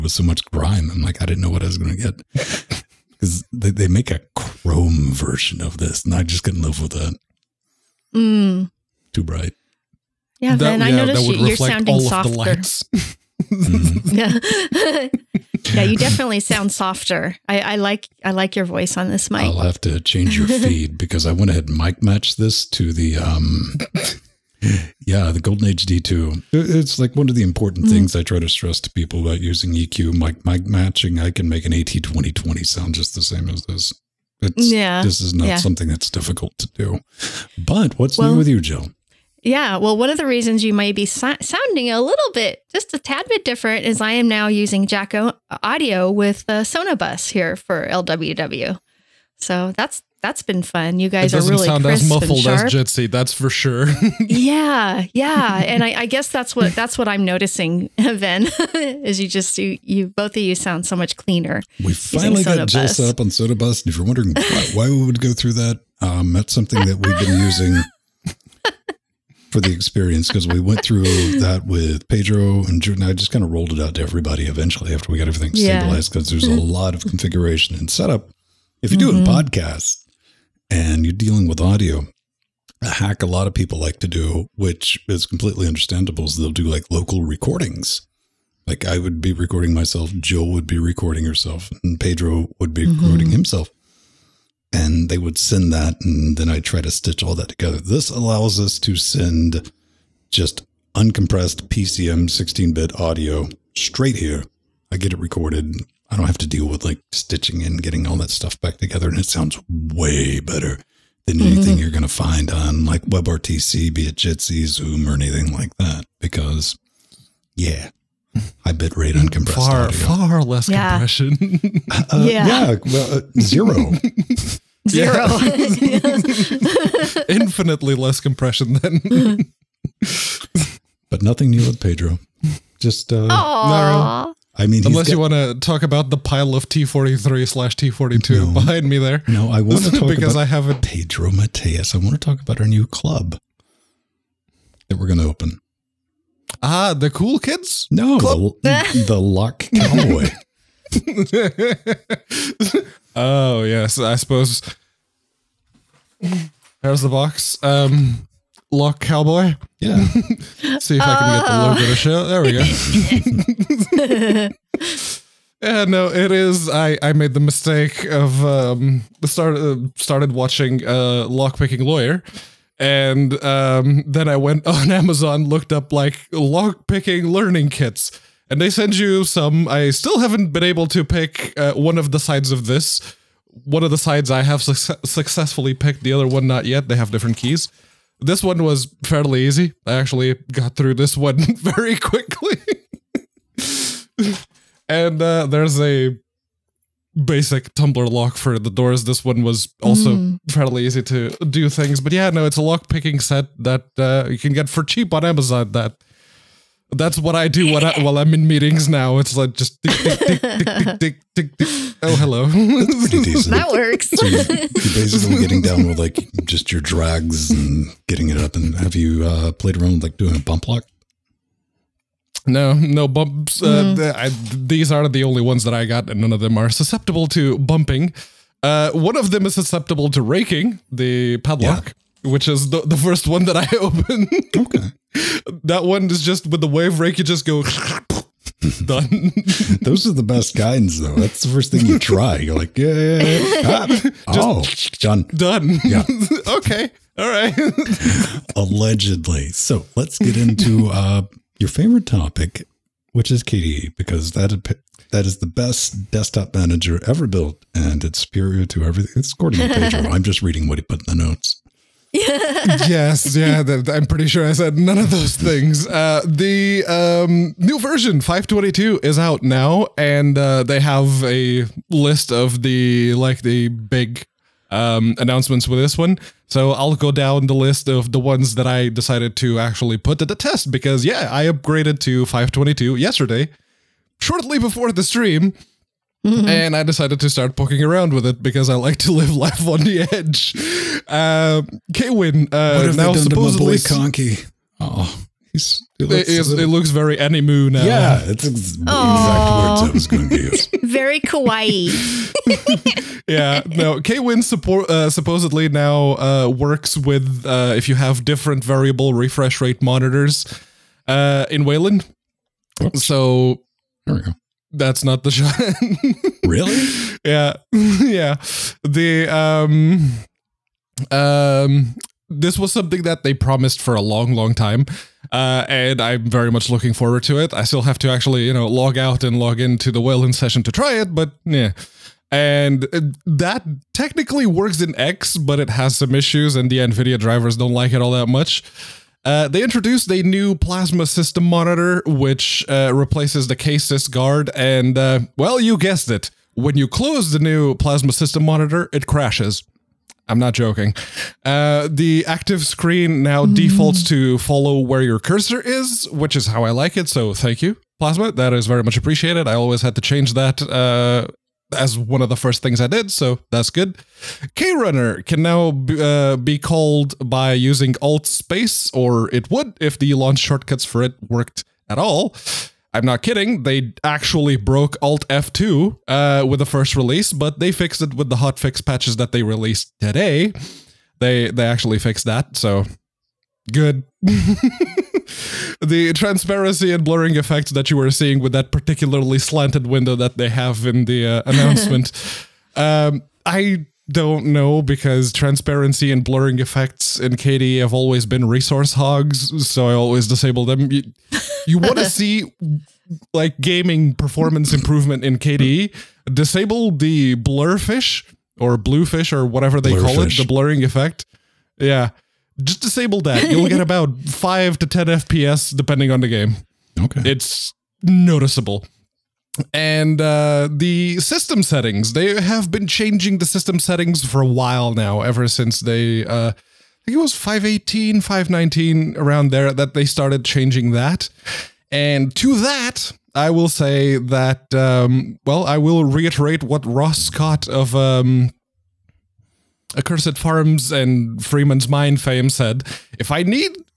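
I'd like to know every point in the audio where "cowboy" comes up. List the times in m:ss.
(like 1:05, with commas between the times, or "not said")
2:29, 2:39.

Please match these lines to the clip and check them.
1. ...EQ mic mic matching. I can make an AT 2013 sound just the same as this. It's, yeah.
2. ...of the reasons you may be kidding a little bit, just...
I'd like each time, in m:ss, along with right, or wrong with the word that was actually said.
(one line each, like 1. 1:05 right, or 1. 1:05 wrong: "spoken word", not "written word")
1. 0:29 wrong: "2020", not "2013"
2. 0:40 wrong: "sounding", not "kidding".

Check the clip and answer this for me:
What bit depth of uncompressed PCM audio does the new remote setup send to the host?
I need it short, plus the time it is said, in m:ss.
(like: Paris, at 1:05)
16-bit, at 1:42.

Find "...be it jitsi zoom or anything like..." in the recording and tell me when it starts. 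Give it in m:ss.
1:53.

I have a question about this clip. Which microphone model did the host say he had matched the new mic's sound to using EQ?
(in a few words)
Golden Age D2.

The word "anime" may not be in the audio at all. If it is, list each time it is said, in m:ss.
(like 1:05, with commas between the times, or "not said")
4:57.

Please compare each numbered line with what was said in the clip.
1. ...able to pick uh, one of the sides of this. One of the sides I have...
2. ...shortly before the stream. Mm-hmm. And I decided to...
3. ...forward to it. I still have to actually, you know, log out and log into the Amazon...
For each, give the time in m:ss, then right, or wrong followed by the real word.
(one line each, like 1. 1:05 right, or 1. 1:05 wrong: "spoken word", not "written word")
1. 3:00 right
2. 4:44 right
3. 5:26 wrong: "Wayland", not "Amazon".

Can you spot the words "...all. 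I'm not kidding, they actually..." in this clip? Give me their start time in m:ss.
6:11.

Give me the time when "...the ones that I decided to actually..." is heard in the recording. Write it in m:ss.
4:38.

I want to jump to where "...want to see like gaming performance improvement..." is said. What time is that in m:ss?
6:41.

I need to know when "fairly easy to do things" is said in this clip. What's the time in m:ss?
3:20.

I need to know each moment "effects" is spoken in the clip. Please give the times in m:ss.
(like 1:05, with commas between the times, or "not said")
6:27, 6:36, 6:50.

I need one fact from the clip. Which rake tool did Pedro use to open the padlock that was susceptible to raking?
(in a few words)
wave rake.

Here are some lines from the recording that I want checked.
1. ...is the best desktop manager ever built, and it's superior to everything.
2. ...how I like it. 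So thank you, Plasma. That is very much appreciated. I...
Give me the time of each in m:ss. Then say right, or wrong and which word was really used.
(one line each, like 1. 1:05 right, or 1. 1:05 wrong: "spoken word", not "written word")
1. 4:15 right
2. 5:56 right.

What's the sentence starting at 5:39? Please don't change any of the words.
Uh, they introduced a new plasma system monitor, which uh, replaces the KSysGuard, and uh, well, you guessed it.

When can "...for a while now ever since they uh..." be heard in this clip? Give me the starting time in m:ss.
7:04.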